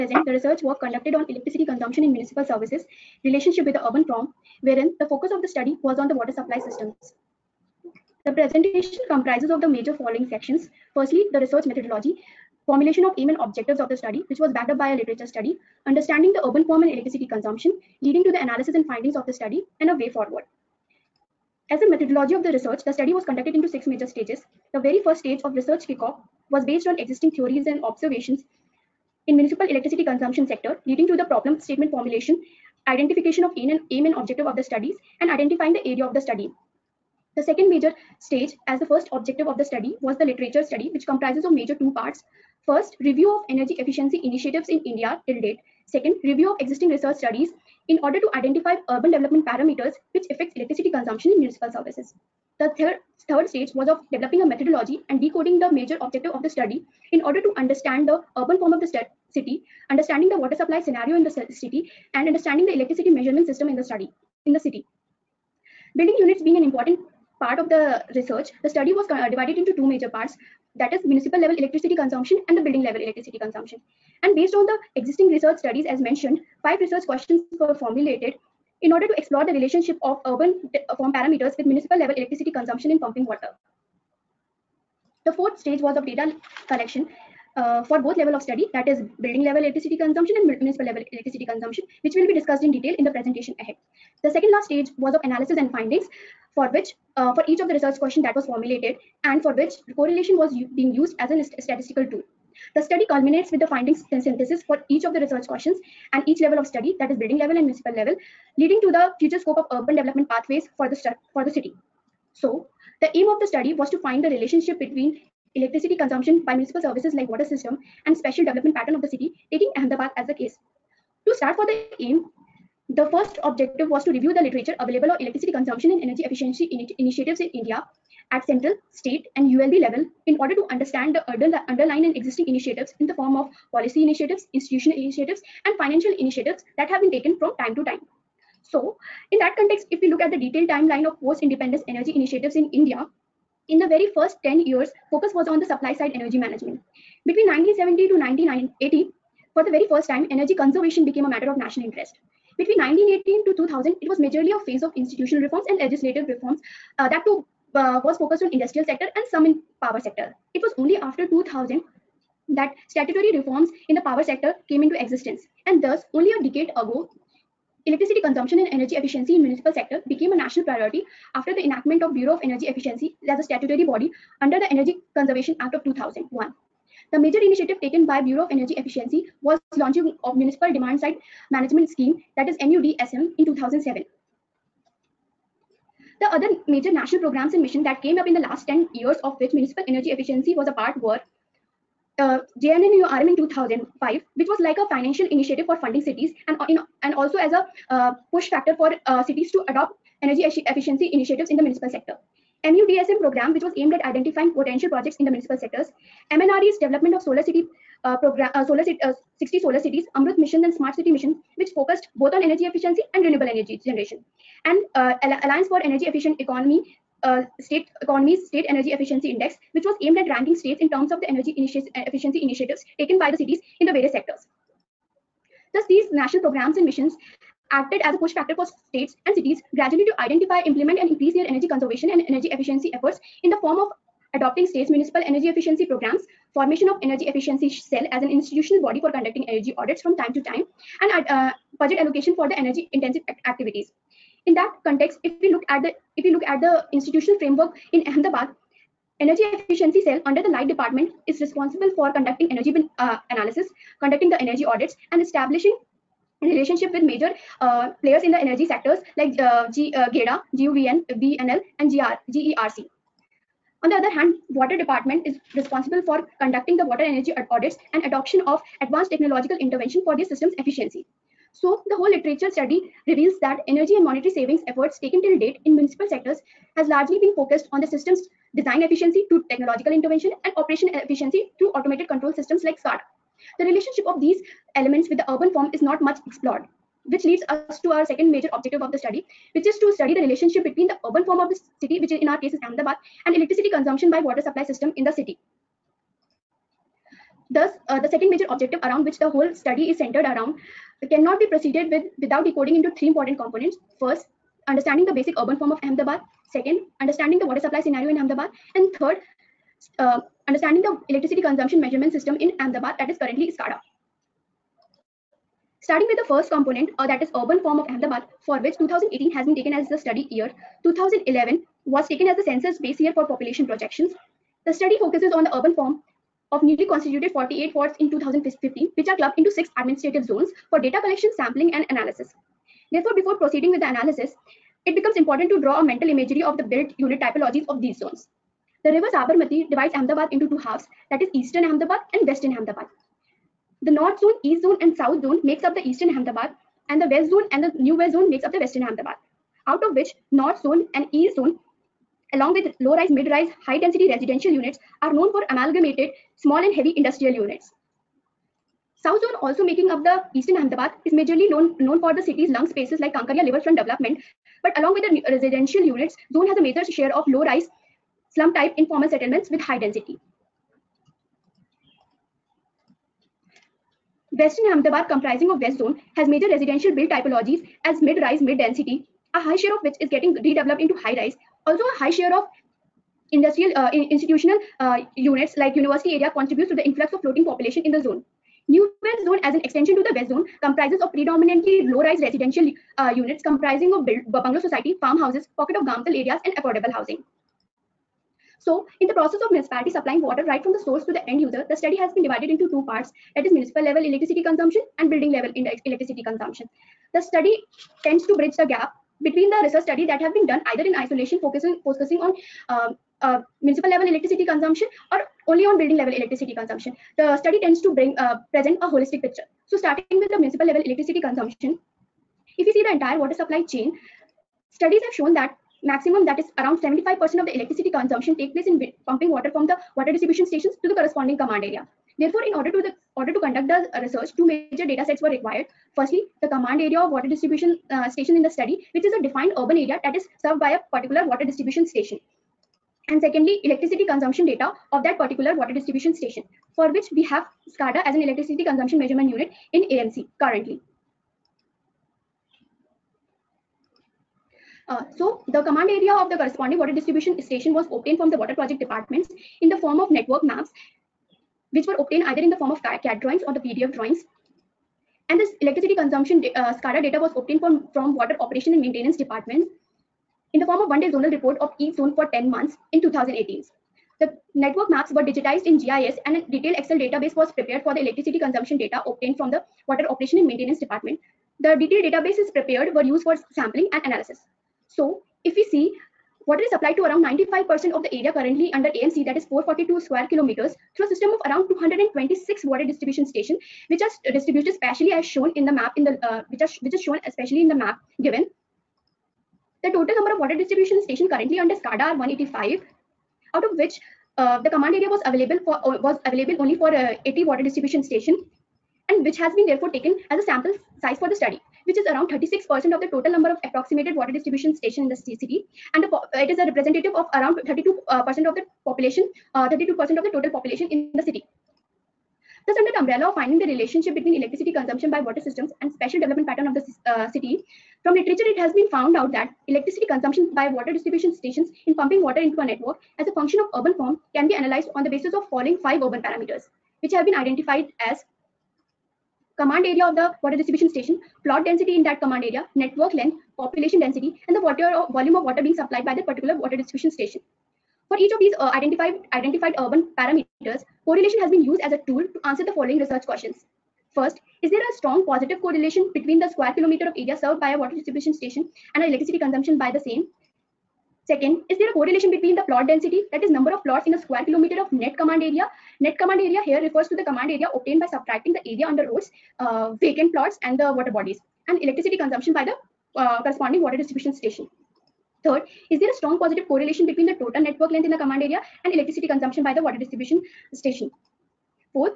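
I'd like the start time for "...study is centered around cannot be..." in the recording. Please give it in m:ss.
4:59.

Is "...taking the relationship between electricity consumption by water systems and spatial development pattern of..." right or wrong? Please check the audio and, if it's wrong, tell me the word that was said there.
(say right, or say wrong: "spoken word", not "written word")
wrong: "finding", not "taking".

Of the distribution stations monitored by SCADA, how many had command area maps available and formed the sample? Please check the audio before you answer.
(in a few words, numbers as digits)
80.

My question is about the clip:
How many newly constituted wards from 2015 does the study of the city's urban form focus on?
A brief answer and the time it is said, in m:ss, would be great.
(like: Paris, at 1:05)
48, at 5:27.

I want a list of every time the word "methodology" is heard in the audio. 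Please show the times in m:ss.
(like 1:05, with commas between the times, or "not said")
0:11, 0:21, 0:54.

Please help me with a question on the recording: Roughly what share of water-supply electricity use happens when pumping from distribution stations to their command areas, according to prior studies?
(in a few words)
75%.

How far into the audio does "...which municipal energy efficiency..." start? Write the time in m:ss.
3:09.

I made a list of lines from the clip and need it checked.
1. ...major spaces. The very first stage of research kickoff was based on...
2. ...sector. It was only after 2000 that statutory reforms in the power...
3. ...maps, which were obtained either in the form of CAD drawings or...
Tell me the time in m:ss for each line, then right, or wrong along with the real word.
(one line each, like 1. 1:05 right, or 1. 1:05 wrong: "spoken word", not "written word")
1. 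0:23 wrong: "stages", not "spaces"
2. 2:39 right
3. 7:40 right.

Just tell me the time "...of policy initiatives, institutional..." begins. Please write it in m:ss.
2:13.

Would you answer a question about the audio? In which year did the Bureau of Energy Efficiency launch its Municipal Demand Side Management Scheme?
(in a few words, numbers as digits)
2007.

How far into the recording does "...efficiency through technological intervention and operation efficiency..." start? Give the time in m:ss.
4:38.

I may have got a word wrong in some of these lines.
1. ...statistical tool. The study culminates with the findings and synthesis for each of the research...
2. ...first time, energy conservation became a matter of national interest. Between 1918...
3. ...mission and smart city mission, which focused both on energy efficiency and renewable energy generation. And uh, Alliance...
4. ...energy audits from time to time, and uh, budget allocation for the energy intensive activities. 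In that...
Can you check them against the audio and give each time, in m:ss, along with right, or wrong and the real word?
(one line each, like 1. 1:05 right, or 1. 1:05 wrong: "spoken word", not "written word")
1. 1:41 right
2. 2:29 right
3. 3:30 right
4. 3:59 right.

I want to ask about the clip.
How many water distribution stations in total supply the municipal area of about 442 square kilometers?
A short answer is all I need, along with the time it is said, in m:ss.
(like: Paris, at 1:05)
226, at 8:11.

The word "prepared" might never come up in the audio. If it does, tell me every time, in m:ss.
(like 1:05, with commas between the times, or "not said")
7:57, 8:02.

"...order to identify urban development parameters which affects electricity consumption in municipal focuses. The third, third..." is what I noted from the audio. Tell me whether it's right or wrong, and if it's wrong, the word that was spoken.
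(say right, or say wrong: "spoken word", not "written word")
wrong: "services", not "focuses".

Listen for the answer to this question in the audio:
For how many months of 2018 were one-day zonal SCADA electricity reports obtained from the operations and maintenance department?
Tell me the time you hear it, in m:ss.
7:52.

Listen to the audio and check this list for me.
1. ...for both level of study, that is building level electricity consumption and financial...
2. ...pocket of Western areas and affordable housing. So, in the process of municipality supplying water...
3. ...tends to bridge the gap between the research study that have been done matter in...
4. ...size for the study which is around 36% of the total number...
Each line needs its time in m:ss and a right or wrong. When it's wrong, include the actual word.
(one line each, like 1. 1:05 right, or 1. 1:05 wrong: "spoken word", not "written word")
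1. 1:27 wrong: "municipal", not "financial"
2. 6:35 wrong: "Gamtal", not "Western"
3. 6:48 wrong: "either", not "matter"
4. 8:31 right.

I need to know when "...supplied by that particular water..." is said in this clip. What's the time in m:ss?
9:05.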